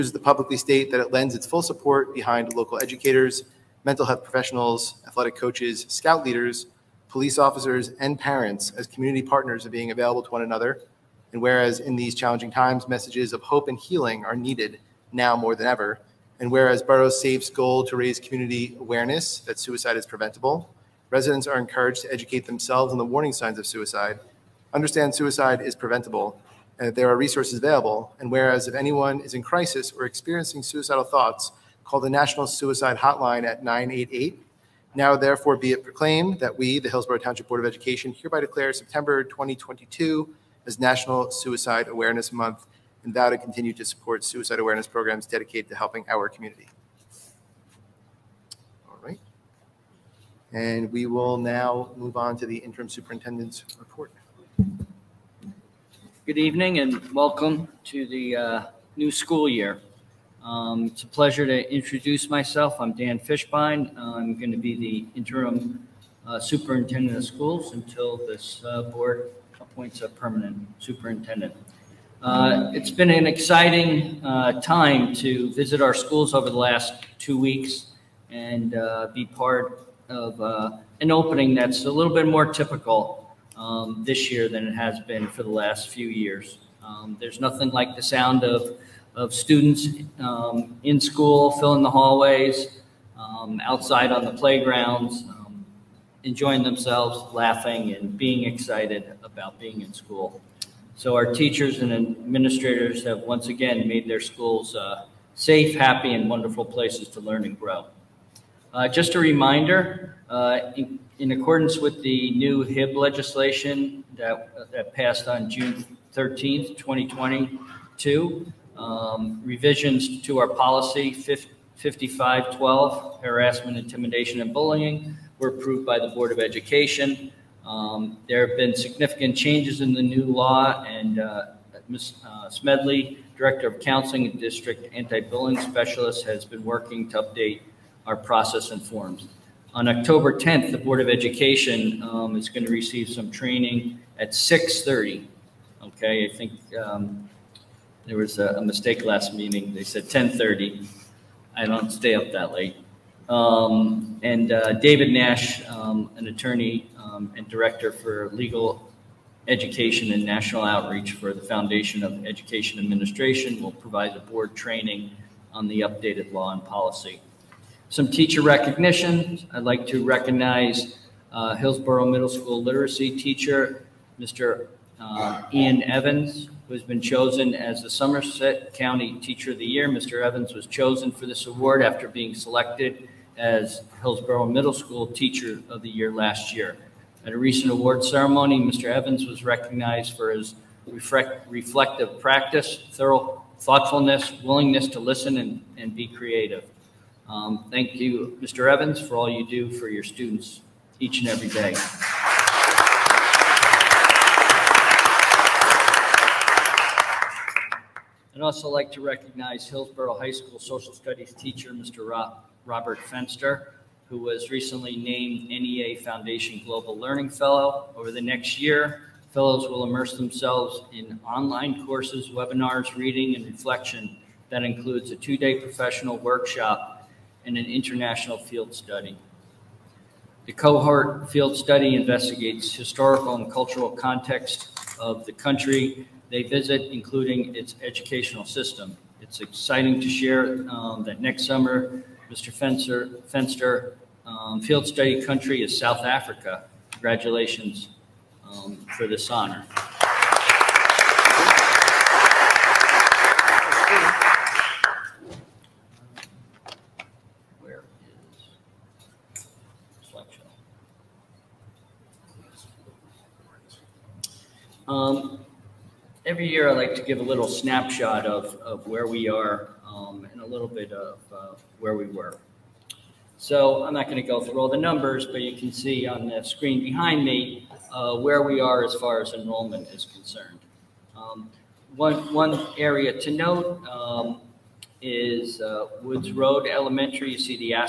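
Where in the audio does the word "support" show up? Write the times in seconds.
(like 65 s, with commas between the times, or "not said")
1 s, 43 s.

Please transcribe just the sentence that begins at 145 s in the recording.
Okay, I think um, there was a, a, mistake last meeting.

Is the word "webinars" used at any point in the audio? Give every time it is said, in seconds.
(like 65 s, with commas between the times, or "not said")
222 s.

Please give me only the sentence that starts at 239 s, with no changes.
It's exciting to share um, that next summer, Mr.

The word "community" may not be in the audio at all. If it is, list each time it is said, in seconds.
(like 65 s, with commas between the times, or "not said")
8 s, 18 s, 46 s.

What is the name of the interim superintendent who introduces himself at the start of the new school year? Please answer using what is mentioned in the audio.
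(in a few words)
Dan Fishbein.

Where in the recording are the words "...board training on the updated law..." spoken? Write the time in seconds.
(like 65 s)
164 s.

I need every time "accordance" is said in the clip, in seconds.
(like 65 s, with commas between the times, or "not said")
111 s.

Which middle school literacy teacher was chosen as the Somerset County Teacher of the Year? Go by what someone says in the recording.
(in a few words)
Ian Evans.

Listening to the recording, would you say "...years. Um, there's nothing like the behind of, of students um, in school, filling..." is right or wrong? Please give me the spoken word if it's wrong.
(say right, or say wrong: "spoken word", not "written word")
wrong: "sound", not "behind".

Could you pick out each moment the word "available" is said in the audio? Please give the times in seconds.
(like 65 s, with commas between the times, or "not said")
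9 s, 27 s.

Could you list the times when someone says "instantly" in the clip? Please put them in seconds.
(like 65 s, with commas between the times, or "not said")
not said.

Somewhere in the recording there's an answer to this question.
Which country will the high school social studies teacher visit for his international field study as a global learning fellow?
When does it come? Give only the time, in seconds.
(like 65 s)
245 s.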